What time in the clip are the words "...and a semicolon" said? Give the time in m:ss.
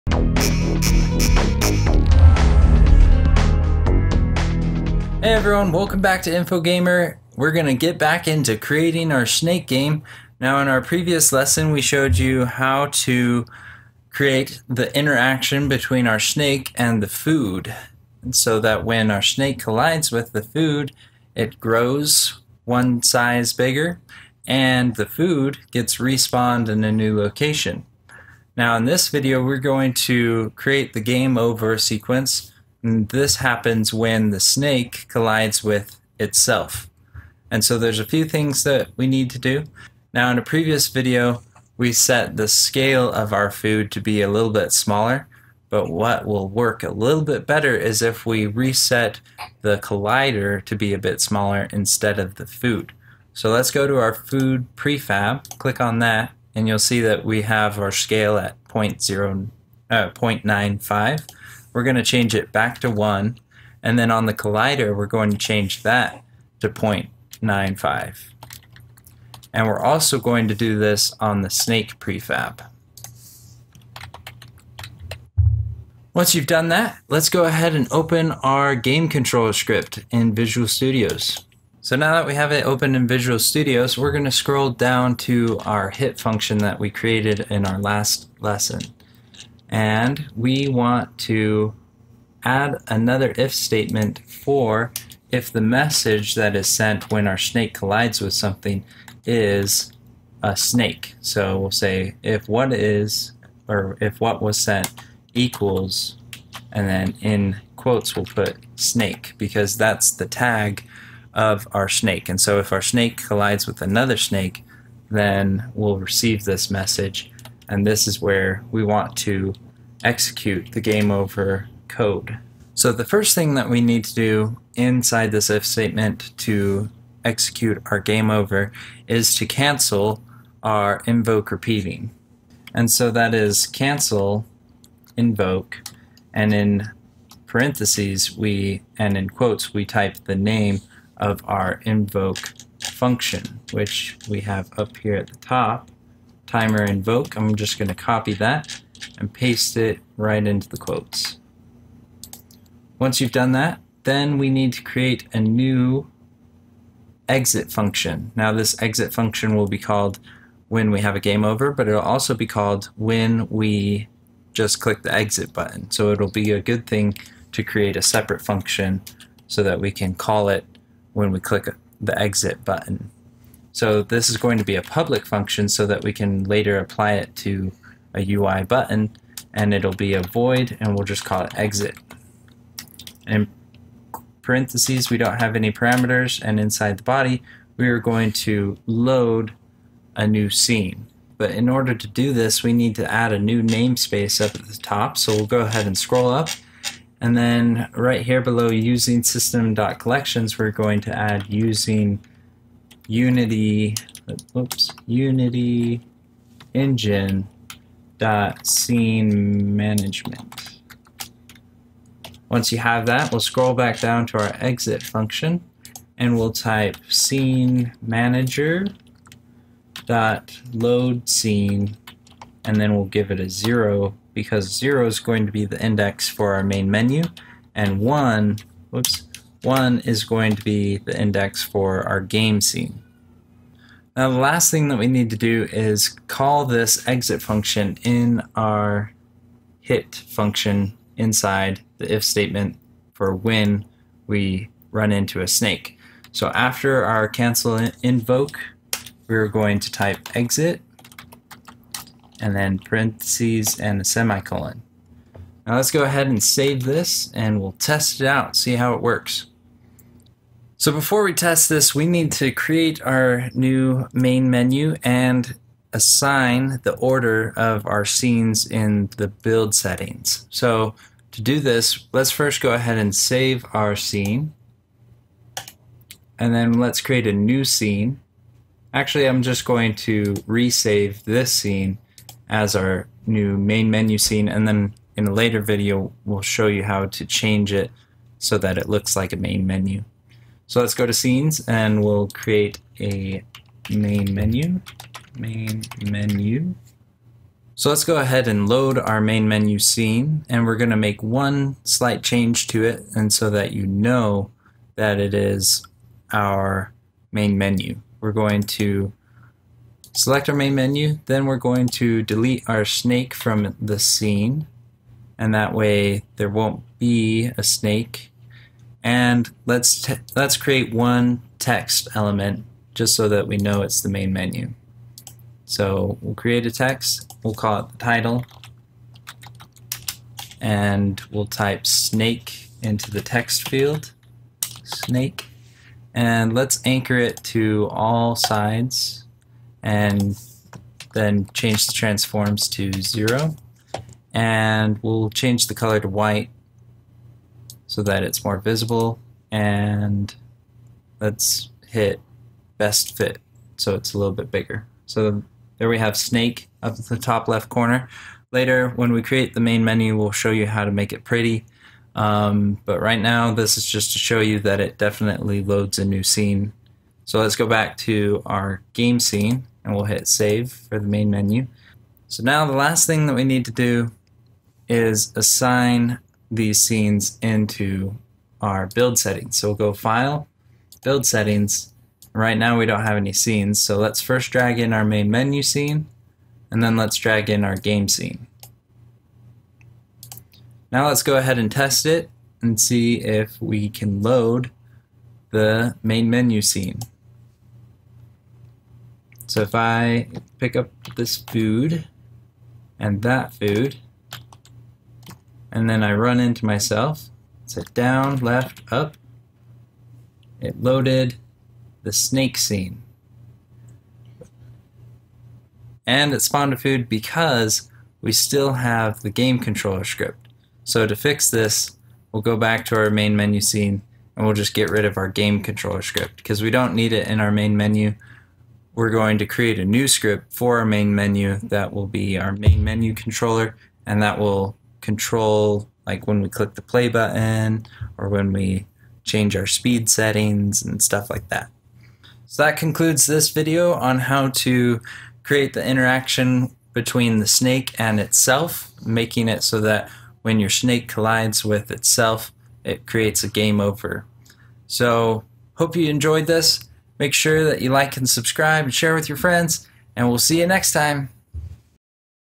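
4:13.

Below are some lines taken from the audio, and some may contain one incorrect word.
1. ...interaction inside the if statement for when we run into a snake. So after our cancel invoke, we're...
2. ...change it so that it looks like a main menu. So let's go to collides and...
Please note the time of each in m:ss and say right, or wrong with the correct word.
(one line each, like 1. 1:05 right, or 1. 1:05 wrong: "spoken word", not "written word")
1. 4:00 wrong: "function", not "interaction"
2. 4:47 wrong: "scenes", not "collides".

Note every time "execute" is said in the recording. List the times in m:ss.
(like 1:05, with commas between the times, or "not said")
2:00, 2:07.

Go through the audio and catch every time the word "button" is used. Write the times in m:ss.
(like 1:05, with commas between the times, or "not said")
2:45, 2:52, 2:58, 7:17.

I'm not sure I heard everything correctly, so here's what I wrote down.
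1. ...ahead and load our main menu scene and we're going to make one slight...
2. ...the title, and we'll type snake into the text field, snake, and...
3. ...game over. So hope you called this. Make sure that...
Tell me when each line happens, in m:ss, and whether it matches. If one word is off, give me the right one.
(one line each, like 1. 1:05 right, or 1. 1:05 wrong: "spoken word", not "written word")
1. 4:58 right
2. 5:27 right
3. 7:33 wrong: "enjoyed", not "called".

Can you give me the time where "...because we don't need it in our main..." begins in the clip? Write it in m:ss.
7:06.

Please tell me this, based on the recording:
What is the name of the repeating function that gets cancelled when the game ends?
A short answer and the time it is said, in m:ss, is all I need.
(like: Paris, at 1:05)
Timer invoke, at 2:26.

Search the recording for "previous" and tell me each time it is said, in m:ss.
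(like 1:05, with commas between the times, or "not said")
0:10, 0:40.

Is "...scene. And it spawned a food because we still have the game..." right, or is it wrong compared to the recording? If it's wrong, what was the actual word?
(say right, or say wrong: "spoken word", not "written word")
right.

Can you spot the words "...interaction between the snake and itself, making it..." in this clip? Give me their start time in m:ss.
7:25.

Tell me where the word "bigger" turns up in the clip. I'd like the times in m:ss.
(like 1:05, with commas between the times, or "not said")
0:23, 5:54.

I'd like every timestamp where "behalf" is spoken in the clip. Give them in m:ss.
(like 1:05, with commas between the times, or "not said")
not said.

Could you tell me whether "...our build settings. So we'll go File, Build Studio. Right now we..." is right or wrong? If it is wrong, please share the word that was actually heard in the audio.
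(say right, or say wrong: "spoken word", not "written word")
wrong: "Settings", not "Studio".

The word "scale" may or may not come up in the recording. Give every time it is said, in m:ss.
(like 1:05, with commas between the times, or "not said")
0:42, 0:57.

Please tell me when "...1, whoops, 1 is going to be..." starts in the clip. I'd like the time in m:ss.
3:47.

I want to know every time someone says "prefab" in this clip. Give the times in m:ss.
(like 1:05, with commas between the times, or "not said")
0:54, 1:11.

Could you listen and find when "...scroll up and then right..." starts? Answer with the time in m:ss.
3:15.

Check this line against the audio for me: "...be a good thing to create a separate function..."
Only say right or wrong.
right.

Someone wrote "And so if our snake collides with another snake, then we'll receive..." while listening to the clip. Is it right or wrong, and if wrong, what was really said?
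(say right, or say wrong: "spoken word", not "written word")
right.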